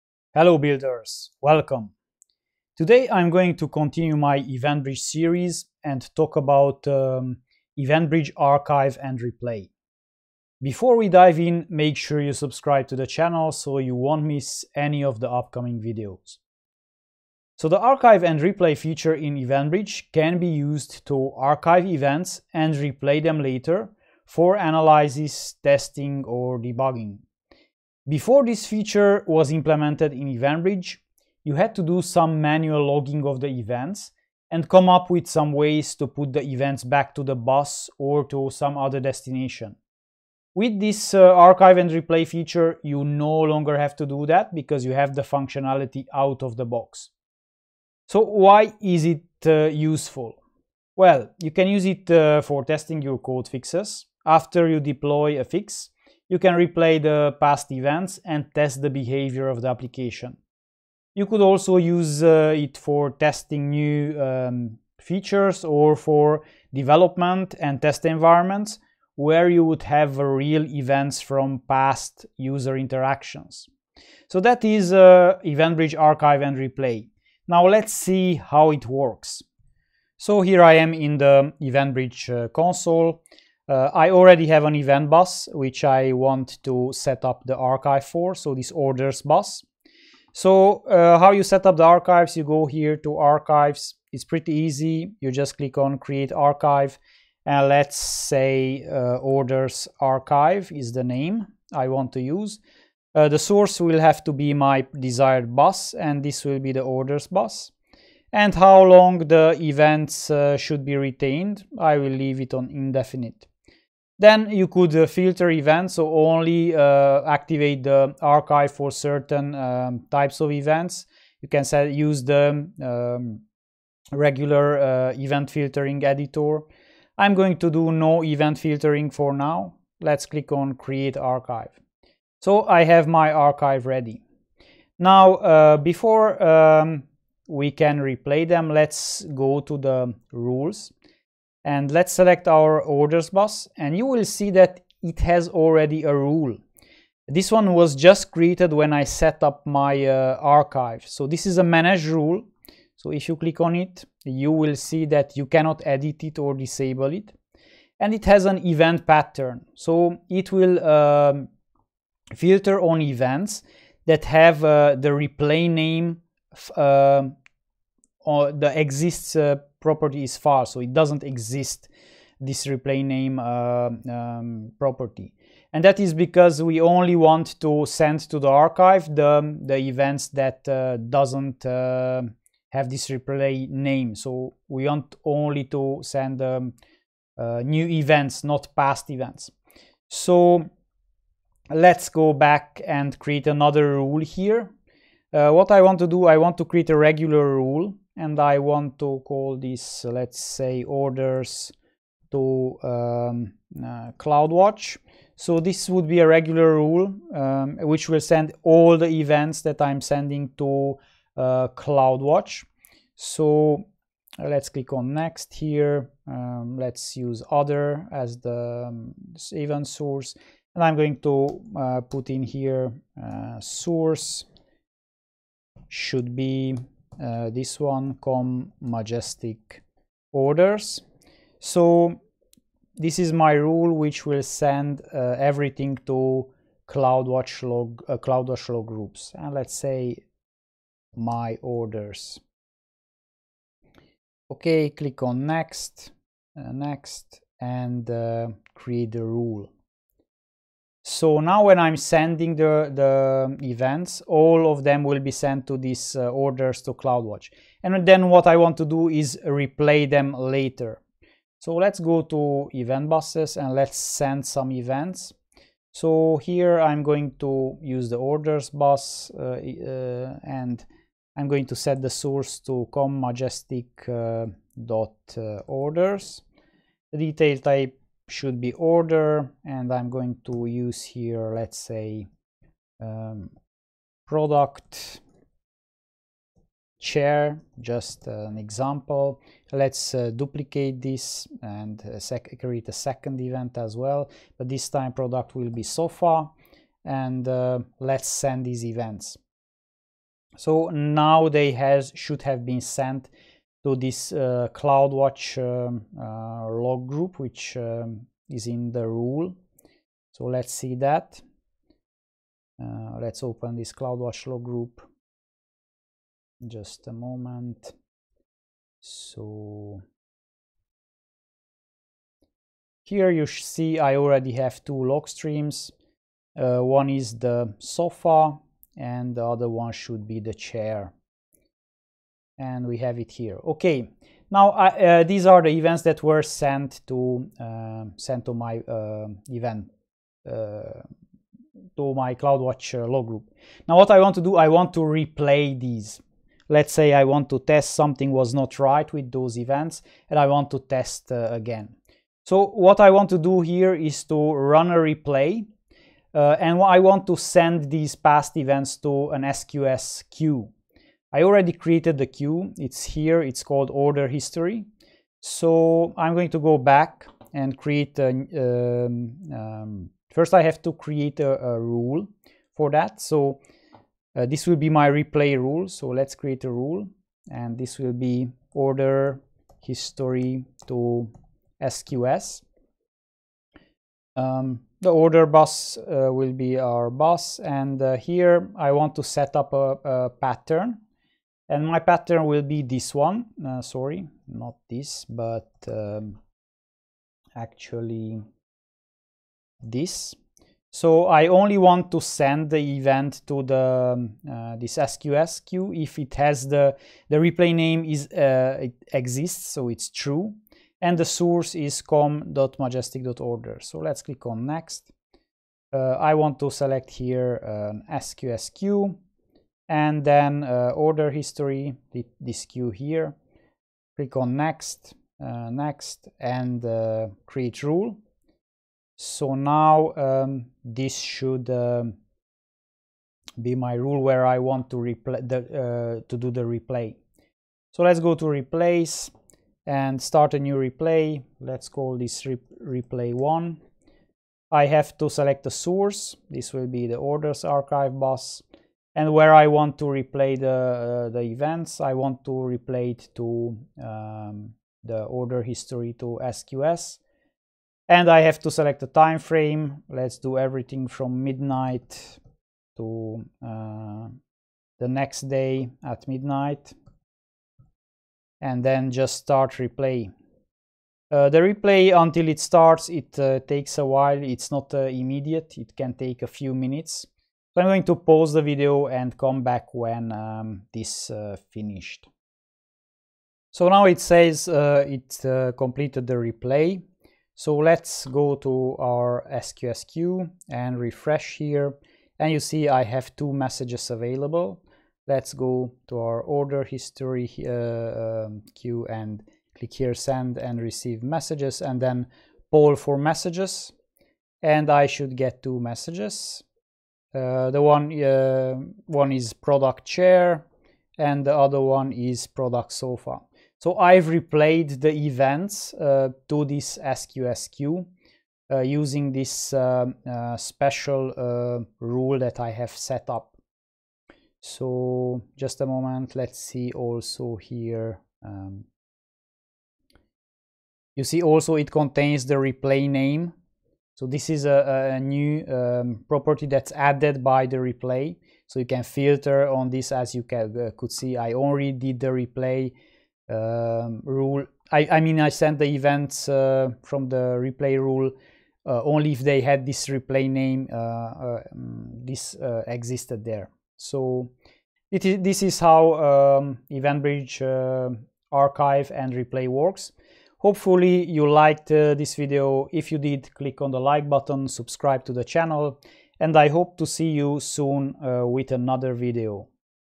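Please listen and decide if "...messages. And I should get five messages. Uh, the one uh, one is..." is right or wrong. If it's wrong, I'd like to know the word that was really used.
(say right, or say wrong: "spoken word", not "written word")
wrong: "two", not "five".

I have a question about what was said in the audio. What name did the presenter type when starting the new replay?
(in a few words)
replay one.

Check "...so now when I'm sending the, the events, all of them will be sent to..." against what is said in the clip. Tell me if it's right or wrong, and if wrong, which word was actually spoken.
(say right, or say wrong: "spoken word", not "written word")
right.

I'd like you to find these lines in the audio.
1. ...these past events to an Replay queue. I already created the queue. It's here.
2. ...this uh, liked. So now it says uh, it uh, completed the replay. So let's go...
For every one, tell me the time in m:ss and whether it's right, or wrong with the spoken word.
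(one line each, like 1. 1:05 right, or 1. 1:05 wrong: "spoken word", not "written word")
1. 5:57 wrong: "SQS", not "Replay"
2. 8:00 wrong: "finished", not "liked".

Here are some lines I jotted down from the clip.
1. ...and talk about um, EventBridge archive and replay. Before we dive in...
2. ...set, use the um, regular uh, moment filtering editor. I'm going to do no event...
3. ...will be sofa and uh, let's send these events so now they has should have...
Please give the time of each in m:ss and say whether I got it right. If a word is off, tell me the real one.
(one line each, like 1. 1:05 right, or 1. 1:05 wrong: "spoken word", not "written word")
1. 0:05 right
2. 2:01 wrong: "event", not "moment"
3. 4:55 right.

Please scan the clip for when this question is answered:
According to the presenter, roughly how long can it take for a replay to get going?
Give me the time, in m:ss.
7:56.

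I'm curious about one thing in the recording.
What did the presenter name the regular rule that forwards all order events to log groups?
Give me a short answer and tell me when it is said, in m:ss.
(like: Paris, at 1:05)
orders to CloudWatch, at 3:20.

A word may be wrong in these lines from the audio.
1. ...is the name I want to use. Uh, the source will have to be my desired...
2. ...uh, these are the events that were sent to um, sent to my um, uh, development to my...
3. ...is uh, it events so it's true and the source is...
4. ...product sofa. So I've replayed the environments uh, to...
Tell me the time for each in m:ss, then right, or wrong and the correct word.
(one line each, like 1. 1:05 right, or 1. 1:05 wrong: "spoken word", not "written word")
1. 1:40 right
2. 5:34 wrong: "event", not "development"
3. 6:48 wrong: "exists", not "events"
4. 8:32 wrong: "events", not "environments".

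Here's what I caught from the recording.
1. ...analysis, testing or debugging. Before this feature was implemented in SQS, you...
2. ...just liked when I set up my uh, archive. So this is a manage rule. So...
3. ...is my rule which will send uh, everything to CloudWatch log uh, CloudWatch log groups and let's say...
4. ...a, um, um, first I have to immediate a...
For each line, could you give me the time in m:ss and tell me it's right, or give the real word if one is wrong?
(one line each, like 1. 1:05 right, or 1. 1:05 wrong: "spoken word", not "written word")
1. 0:24 wrong: "EventBridge", not "SQS"
2. 2:27 wrong: "created", not "liked"
3. 3:53 right
4. 6:08 wrong: "create", not "immediate".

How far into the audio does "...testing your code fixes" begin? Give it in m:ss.
0:52.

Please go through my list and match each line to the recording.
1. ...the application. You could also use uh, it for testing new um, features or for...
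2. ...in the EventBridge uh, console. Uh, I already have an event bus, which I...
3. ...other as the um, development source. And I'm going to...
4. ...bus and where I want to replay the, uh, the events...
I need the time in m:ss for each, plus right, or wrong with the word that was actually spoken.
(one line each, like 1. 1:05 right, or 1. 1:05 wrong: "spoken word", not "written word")
1. 0:59 right
2. 1:20 right
3. 3:37 wrong: "event", not "development"
4. 7:28 right.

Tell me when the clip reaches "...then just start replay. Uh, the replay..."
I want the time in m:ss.
7:48.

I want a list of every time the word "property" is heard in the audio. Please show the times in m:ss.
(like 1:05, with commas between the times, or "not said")
2:49, 2:54, 8:56.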